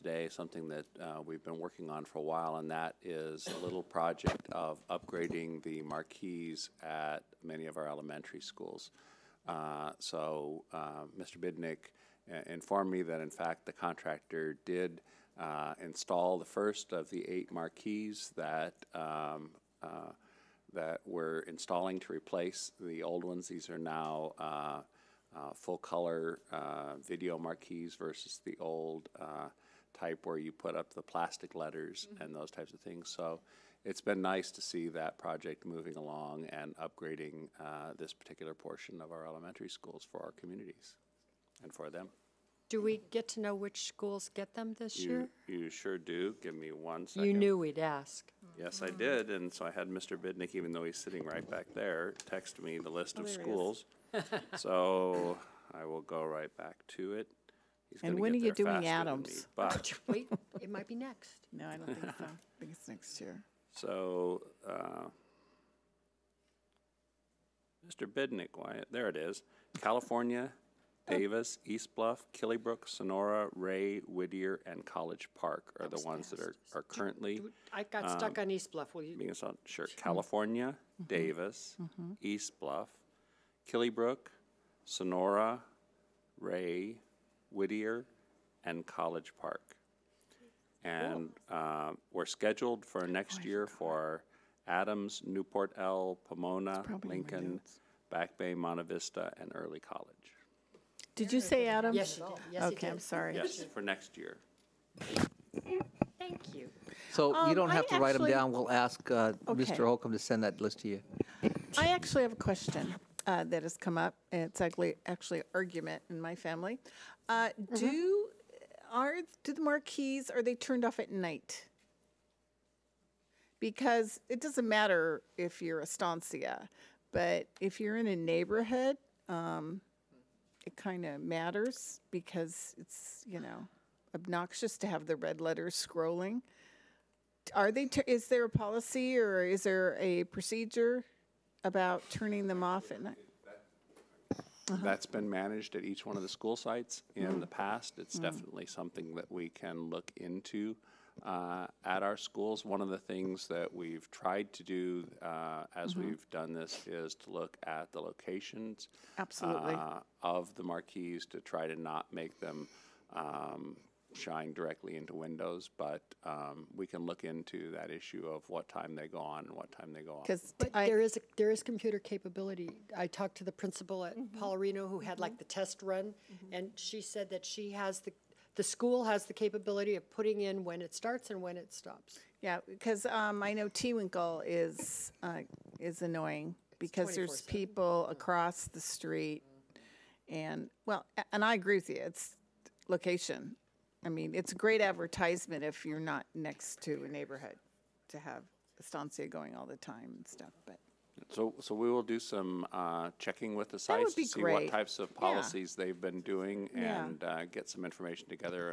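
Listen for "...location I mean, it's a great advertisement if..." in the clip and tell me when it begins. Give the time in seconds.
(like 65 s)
192 s.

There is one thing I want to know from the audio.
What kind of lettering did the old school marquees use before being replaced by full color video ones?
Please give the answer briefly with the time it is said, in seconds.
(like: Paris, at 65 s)
plastic letters, at 31 s.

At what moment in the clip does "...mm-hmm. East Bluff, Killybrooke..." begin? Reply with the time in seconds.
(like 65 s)
81 s.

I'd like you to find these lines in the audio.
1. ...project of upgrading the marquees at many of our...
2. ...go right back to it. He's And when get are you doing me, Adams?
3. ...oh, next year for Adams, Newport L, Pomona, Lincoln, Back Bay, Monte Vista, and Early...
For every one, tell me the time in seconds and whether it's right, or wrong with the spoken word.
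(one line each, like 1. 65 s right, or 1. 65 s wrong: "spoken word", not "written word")
1. 3 s right
2. 56 s right
3. 93 s right.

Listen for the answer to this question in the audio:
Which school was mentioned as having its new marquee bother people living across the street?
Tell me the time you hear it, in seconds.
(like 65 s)
183 s.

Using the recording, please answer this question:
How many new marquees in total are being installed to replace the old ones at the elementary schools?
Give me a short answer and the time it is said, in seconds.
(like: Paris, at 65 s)
8, at 17 s.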